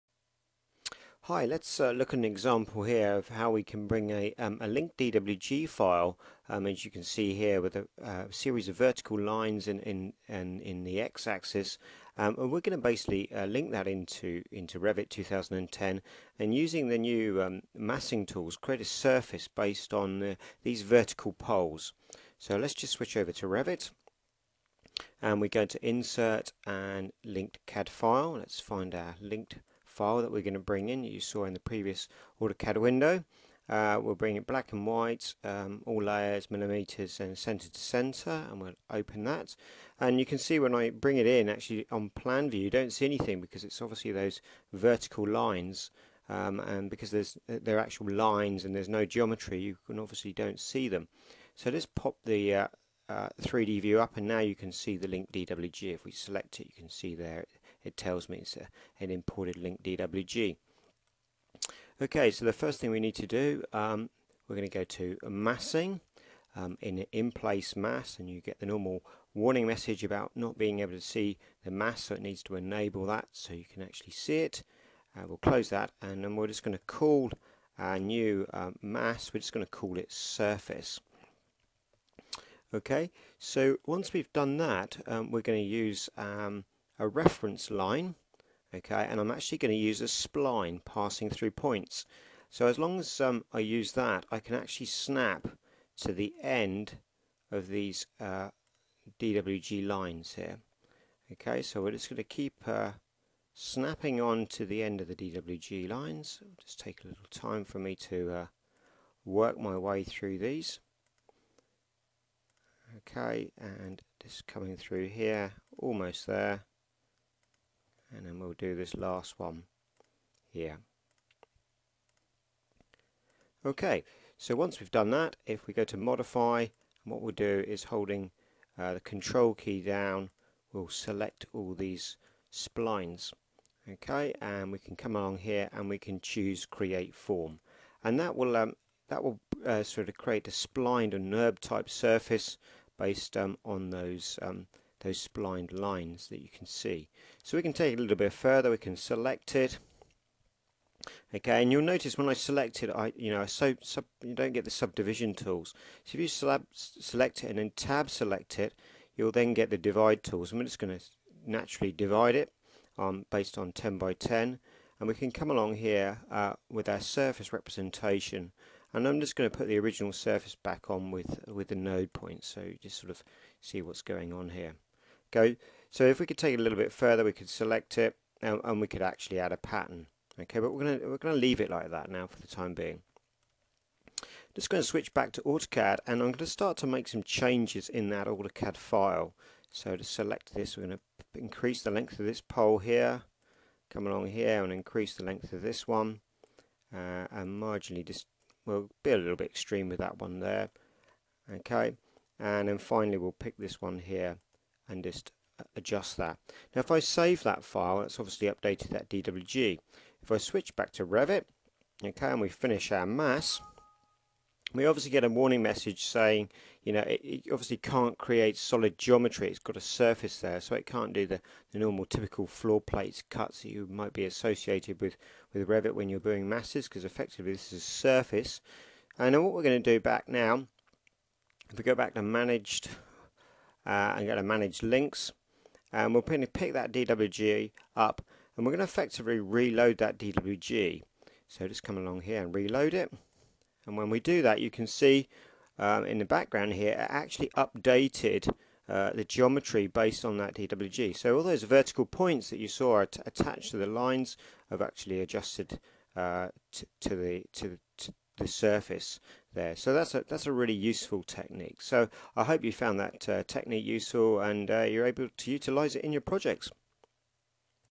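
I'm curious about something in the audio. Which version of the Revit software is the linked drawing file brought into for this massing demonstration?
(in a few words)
Revit 2010.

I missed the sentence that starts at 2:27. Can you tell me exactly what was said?
So we can take it a little bit further, we can select it.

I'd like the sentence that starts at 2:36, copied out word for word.
So if you slab, select it and then tab select it, you'll then get the divide tools.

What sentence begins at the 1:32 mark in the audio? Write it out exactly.
So as long as um, I use that, I can actually snap to the end of these uh, DWG lines here.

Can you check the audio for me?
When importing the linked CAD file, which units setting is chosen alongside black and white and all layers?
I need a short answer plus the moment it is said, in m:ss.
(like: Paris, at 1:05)
millimeters, at 0:36.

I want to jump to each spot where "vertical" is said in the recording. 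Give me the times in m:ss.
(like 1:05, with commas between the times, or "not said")
0:08, 0:20, 0:44, 4:11.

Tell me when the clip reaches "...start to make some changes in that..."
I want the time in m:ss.
3:06.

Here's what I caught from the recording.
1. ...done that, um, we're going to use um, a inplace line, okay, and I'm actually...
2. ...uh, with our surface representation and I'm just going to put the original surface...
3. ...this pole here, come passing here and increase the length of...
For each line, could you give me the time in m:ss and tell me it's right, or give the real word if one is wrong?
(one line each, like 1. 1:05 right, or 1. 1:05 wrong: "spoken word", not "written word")
1. 1:24 wrong: "reference", not "inplace"
2. 2:46 right
3. 3:12 wrong: "along", not "passing".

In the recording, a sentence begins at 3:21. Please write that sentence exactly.
Okay, and then finally we'll pick this one here and just uh, adjust that.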